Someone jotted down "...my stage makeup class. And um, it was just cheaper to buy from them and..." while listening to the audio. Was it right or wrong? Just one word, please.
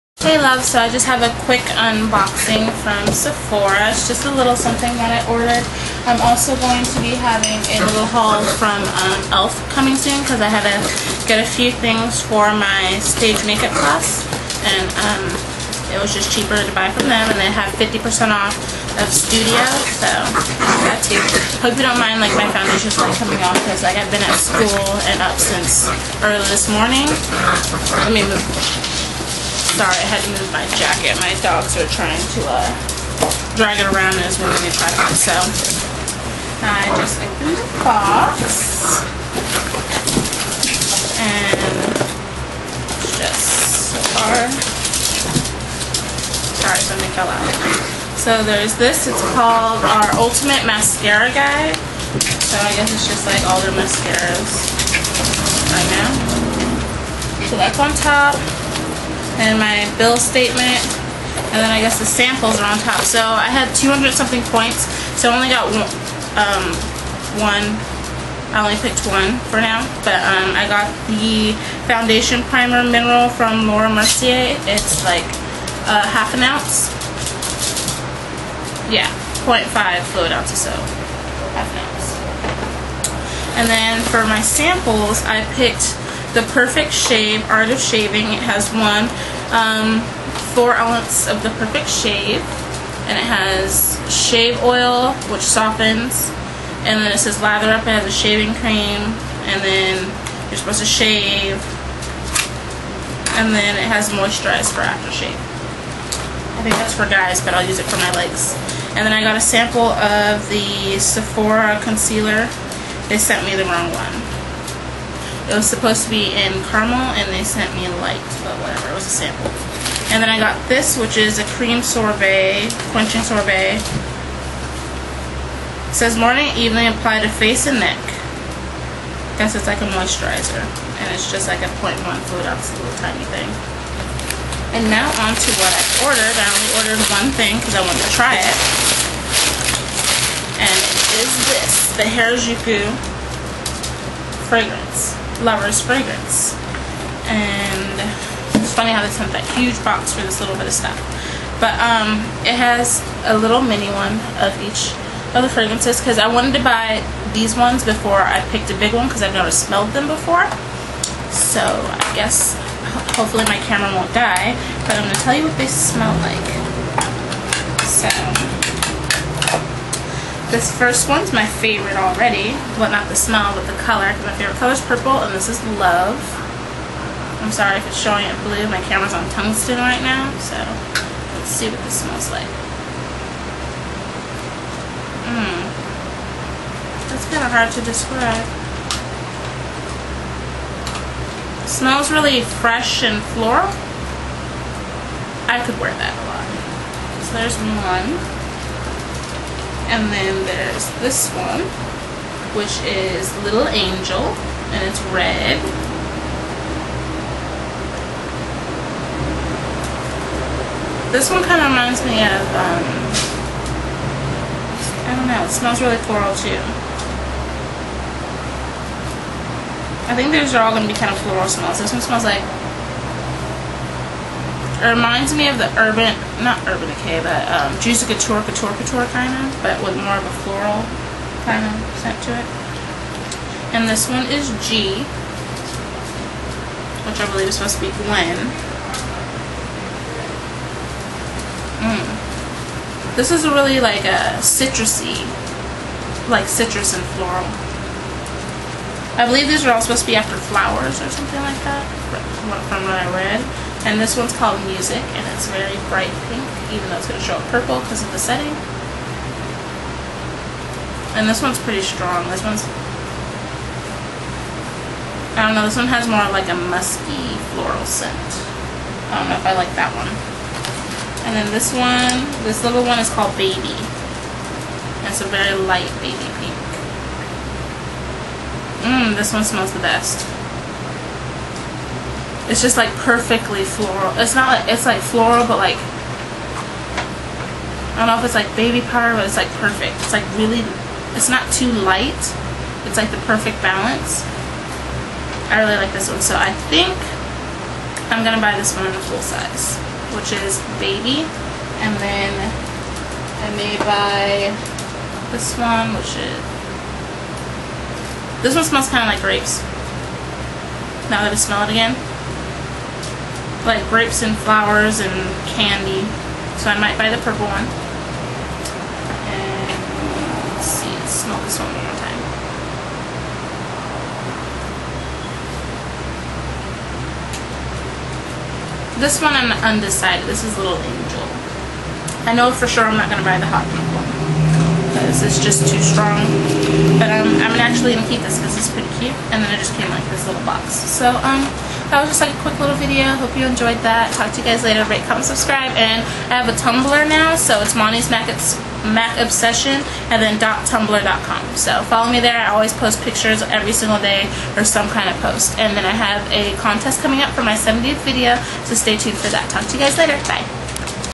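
right.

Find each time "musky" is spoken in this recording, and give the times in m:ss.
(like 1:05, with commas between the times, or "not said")
4:26.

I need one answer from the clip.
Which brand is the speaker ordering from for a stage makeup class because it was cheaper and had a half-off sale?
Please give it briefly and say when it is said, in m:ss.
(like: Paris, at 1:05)
e.l.f., at 0:09.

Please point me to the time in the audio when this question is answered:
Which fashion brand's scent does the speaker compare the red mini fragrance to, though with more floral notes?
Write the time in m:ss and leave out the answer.
3:47.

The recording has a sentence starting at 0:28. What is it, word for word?
Let me move sorry, I had to move my jacket.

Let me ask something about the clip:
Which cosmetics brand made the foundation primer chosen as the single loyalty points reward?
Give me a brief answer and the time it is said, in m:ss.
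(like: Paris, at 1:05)
Laura Mercier, at 1:13.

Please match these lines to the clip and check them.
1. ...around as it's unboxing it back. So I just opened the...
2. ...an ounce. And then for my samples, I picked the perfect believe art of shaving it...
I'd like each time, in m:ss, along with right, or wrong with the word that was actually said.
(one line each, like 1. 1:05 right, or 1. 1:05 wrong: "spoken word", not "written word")
1. 0:33 wrong: "moving", not "unboxing"
2. 1:21 wrong: "shave", not "believe".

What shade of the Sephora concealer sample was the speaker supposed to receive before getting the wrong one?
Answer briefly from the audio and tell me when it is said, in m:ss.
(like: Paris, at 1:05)
caramel, at 1:56.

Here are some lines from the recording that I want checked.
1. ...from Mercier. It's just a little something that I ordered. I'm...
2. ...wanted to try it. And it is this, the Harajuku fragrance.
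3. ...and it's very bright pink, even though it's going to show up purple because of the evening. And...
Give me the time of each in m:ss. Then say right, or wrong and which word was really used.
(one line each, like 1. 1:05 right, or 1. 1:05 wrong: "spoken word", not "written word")
1. 0:02 wrong: "Sephora", not "Mercier"
2. 2:17 right
3. 4:15 wrong: "setting", not "evening".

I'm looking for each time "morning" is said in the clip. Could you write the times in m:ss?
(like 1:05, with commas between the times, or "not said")
0:26, 2:06.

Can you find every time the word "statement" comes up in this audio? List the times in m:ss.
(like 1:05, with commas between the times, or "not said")
1:00.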